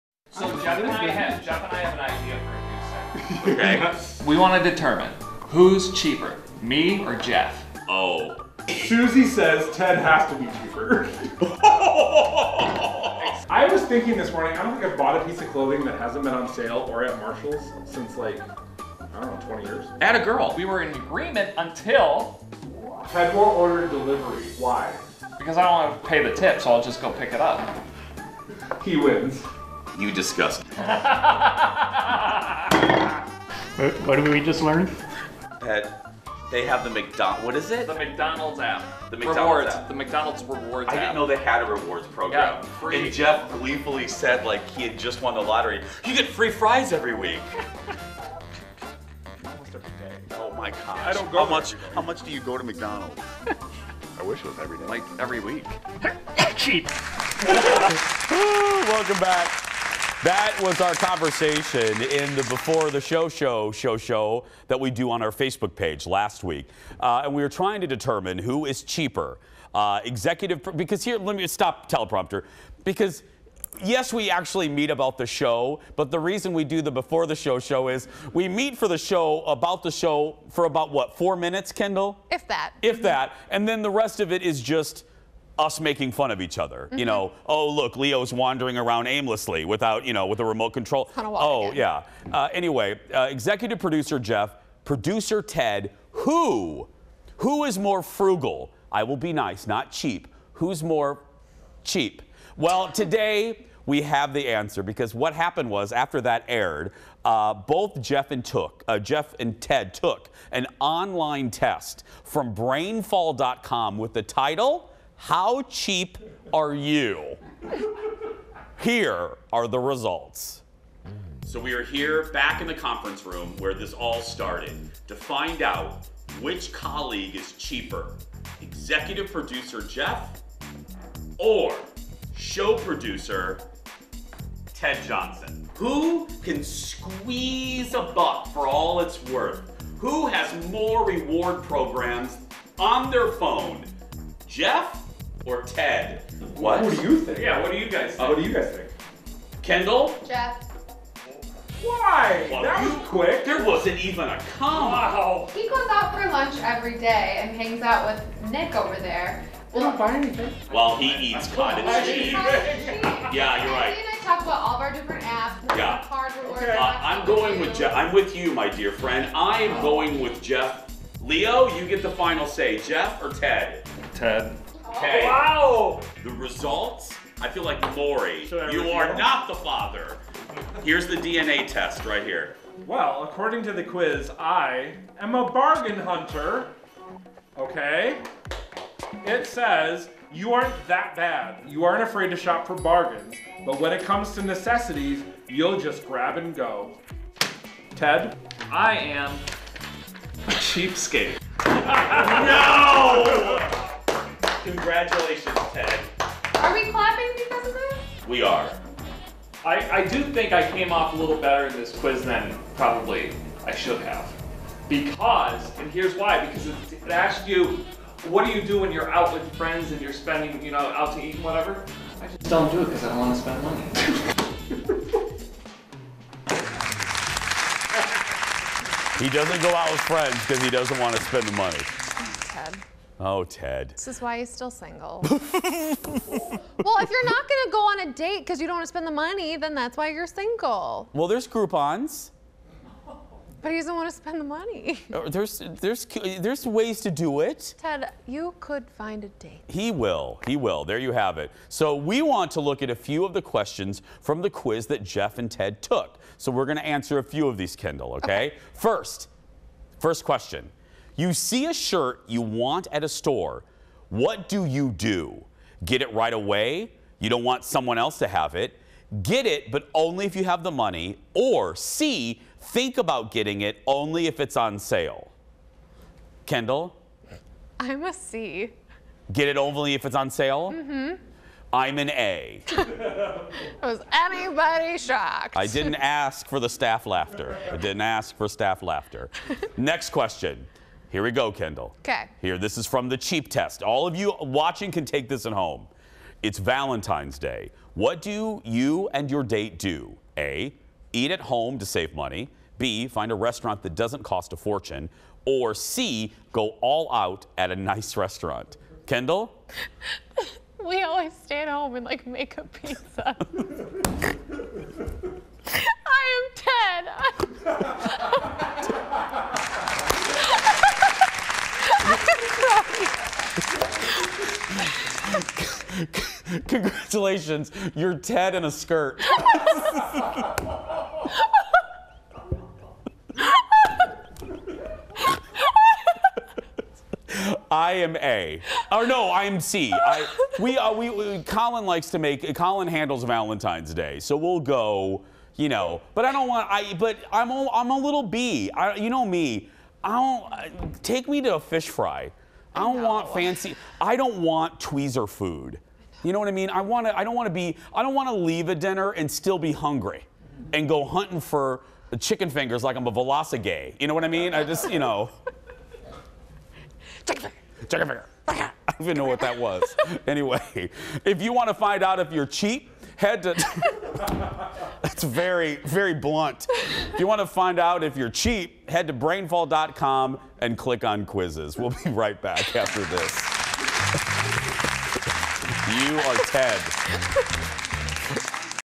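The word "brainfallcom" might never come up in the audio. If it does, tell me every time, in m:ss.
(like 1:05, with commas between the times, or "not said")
1:52, 6:19.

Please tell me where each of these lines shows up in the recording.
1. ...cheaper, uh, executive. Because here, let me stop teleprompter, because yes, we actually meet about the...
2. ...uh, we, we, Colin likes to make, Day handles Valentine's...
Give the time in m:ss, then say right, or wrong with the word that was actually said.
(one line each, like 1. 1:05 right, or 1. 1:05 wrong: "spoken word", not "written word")
1. 1:08 right
2. 5:40 wrong: "Colin", not "Day".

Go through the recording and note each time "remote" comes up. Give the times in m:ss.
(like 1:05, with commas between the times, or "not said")
1:30.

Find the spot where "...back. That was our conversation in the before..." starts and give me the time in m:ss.
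0:59.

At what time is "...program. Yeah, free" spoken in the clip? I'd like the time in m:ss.
0:42.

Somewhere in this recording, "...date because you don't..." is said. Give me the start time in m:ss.
3:58.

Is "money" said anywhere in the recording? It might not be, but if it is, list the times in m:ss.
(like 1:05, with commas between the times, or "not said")
3:43, 3:51, 3:59, 4:04, 4:30, 5:02.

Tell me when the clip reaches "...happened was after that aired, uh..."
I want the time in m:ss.
1:45.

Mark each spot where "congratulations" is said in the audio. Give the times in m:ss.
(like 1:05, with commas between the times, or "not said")
3:24, 5:27.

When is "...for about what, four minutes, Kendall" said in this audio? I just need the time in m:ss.
1:20.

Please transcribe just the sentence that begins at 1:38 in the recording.
I will be nice, not cheap.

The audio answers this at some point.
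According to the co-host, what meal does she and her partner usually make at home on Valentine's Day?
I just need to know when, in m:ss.
5:12.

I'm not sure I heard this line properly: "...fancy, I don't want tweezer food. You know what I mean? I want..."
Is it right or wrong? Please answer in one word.
right.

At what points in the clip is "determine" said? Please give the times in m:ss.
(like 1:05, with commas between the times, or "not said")
0:04, 1:07.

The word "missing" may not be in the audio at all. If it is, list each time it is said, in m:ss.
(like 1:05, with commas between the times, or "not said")
not said.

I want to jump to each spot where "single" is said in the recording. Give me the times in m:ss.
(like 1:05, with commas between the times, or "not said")
3:54, 4:00.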